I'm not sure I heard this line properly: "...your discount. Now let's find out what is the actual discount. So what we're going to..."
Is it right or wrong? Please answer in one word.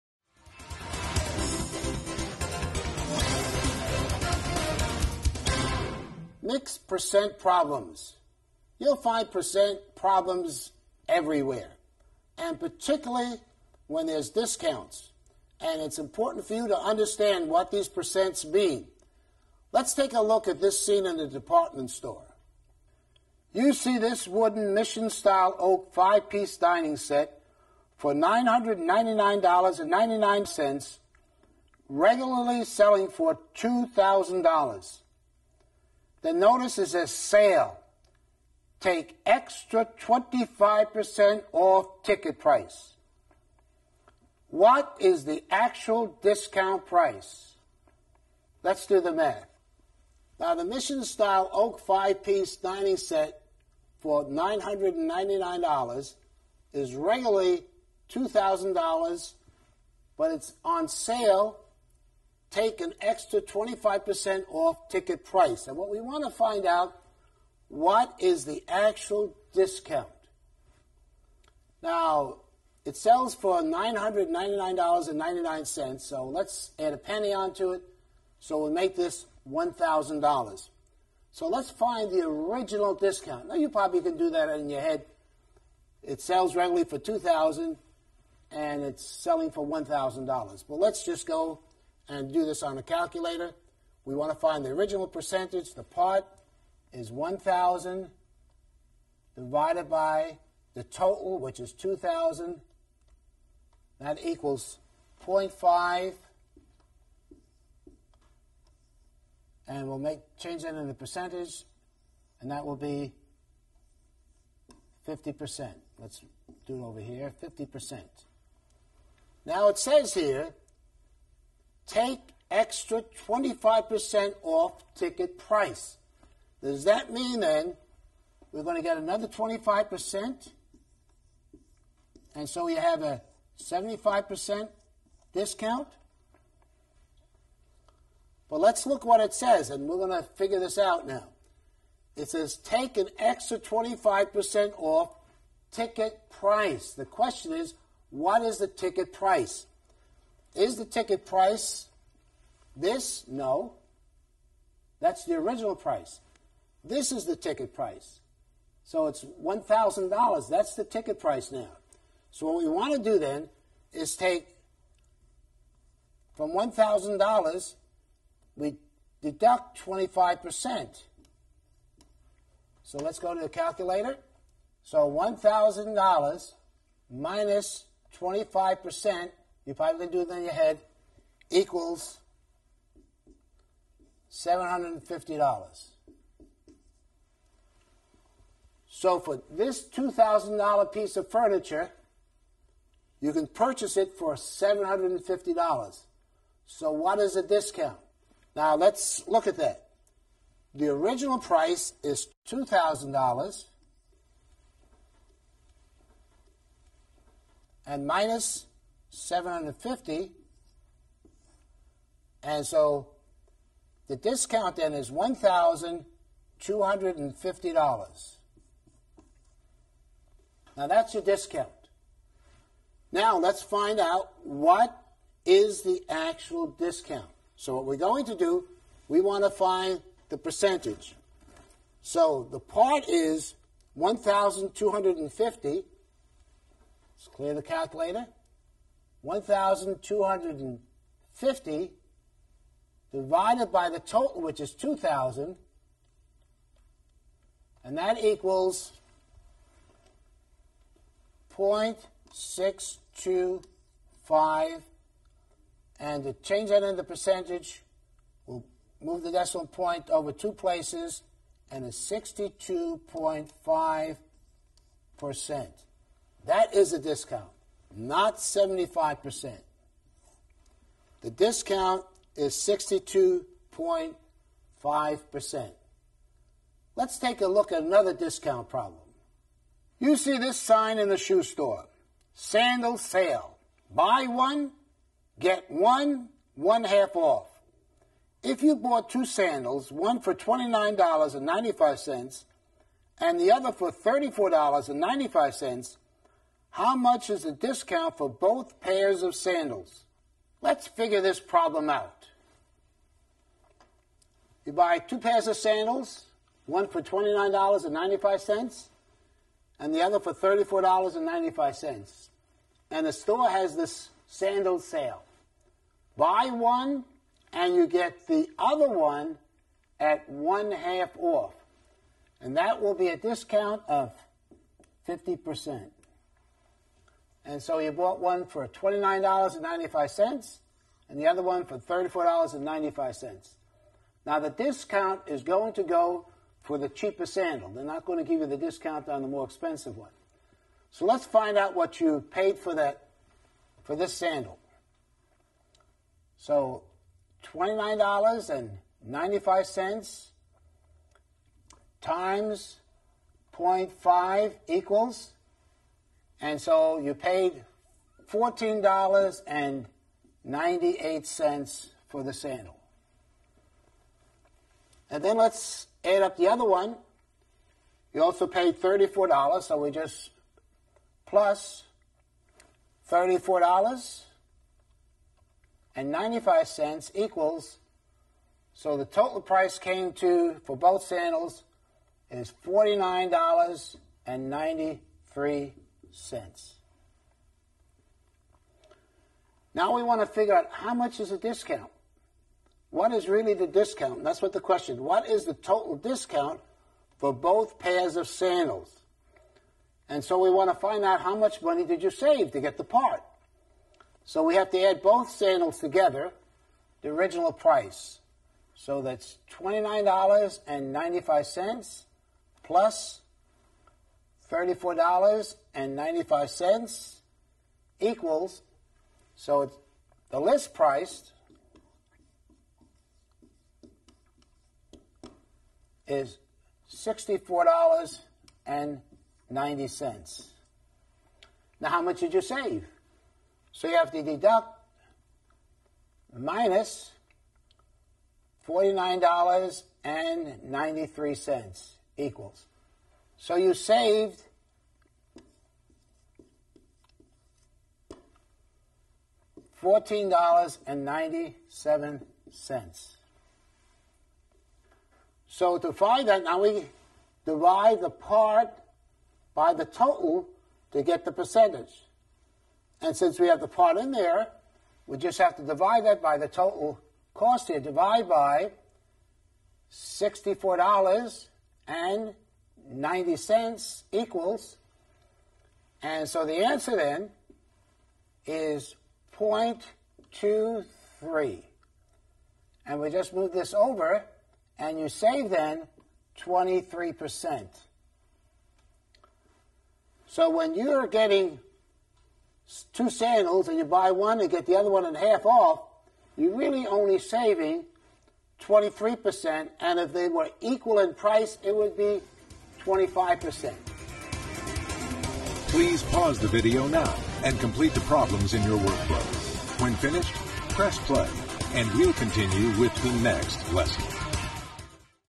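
right.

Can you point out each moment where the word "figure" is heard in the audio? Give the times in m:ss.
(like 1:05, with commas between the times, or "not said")
2:20, 5:00, 6:30.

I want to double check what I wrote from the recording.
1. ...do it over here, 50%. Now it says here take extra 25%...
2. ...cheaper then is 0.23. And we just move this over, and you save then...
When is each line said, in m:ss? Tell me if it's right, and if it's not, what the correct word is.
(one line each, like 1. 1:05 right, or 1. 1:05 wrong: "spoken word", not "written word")
1. 1:56 right
2. 7:56 wrong: "answer", not "cheaper".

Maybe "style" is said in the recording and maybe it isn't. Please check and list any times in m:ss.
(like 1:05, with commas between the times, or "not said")
0:25, 0:51.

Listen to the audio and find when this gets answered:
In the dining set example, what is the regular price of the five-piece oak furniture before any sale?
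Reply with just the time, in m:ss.
0:31.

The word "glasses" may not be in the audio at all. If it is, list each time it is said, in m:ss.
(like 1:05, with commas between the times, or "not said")
not said.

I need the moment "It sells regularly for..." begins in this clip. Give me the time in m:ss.
1:26.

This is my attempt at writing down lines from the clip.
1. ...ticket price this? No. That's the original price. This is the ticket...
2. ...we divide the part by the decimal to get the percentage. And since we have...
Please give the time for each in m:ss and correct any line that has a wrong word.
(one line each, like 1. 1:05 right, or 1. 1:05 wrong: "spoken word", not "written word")
1. 2:30 right
2. 7:36 wrong: "total", not "decimal".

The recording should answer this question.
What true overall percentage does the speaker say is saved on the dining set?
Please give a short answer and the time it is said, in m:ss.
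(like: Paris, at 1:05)
62.5%, at 4:21.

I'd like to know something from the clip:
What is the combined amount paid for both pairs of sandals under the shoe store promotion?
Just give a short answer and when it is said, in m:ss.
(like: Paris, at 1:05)
$49.93, at 6:22.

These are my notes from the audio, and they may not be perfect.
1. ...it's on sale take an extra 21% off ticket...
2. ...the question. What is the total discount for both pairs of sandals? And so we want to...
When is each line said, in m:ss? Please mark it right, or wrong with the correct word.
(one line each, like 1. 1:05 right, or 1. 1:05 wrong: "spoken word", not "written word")
1. 1:00 wrong: "25", not "21"
2. 6:34 right.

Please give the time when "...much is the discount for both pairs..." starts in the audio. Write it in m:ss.
4:56.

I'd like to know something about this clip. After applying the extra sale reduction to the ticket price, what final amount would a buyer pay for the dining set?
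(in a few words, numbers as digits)
$750.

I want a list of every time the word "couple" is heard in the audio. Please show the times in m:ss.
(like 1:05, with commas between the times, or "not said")
not said.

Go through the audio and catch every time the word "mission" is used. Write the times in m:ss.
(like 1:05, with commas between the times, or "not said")
0:24, 0:50.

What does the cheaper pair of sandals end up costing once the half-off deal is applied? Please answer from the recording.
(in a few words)
$14.98.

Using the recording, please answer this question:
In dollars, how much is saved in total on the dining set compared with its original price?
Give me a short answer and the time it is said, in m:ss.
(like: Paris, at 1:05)
$1,250, at 3:34.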